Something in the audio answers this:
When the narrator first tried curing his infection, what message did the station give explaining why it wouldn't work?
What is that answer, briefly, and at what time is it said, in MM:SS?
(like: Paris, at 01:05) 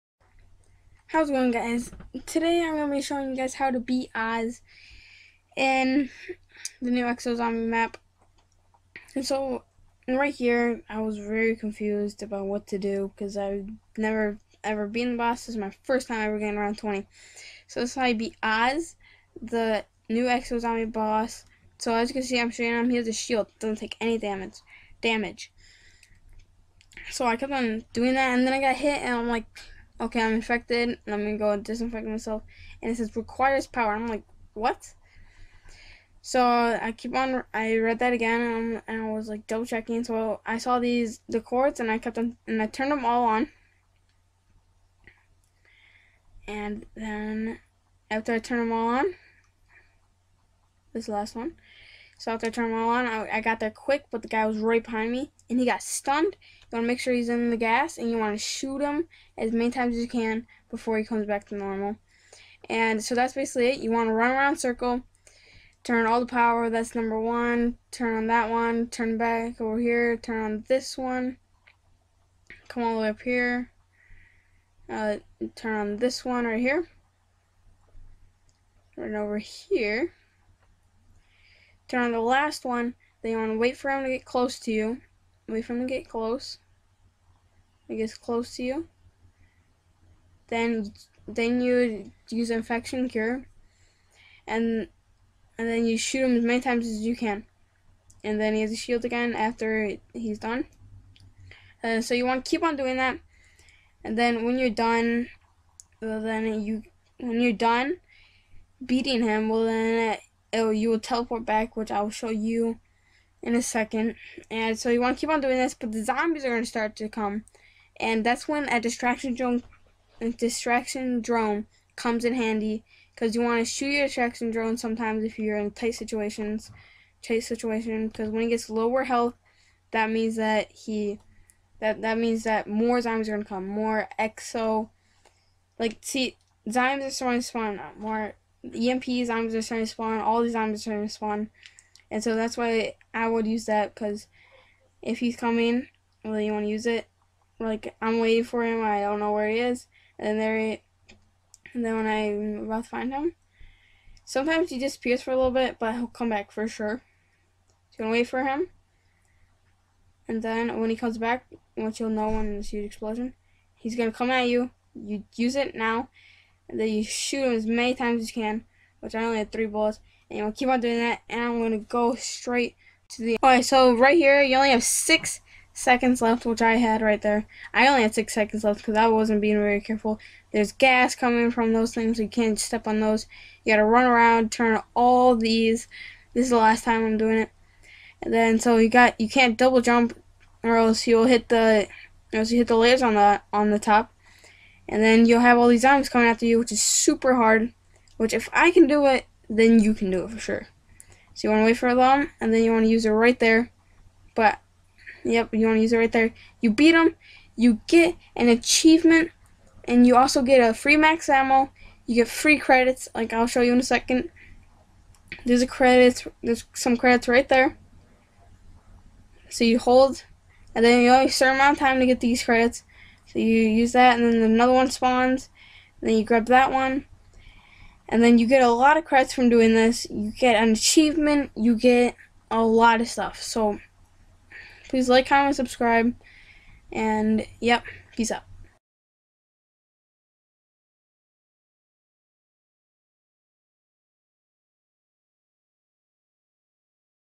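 Requires power, at 00:33.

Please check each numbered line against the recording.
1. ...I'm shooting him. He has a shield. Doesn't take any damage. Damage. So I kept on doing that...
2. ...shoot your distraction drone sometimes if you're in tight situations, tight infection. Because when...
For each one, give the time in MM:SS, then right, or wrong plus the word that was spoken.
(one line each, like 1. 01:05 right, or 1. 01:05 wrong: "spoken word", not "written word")
1. 00:22 right
2. 02:03 wrong: "situation", not "infection".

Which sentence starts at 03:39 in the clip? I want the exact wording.
So you hold, and then you only certain amount of time to get these credits.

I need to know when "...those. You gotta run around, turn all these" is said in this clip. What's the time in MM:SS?
03:03.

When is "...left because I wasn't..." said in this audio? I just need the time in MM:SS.
02:58.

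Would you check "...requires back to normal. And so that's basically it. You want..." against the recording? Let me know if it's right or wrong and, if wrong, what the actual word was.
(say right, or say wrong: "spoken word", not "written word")
wrong: "comes", not "requires".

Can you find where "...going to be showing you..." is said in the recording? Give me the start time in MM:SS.
00:02.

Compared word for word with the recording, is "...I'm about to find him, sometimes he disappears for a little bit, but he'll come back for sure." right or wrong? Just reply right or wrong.
right.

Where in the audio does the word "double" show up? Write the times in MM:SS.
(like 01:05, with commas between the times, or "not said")
00:39, 03:09.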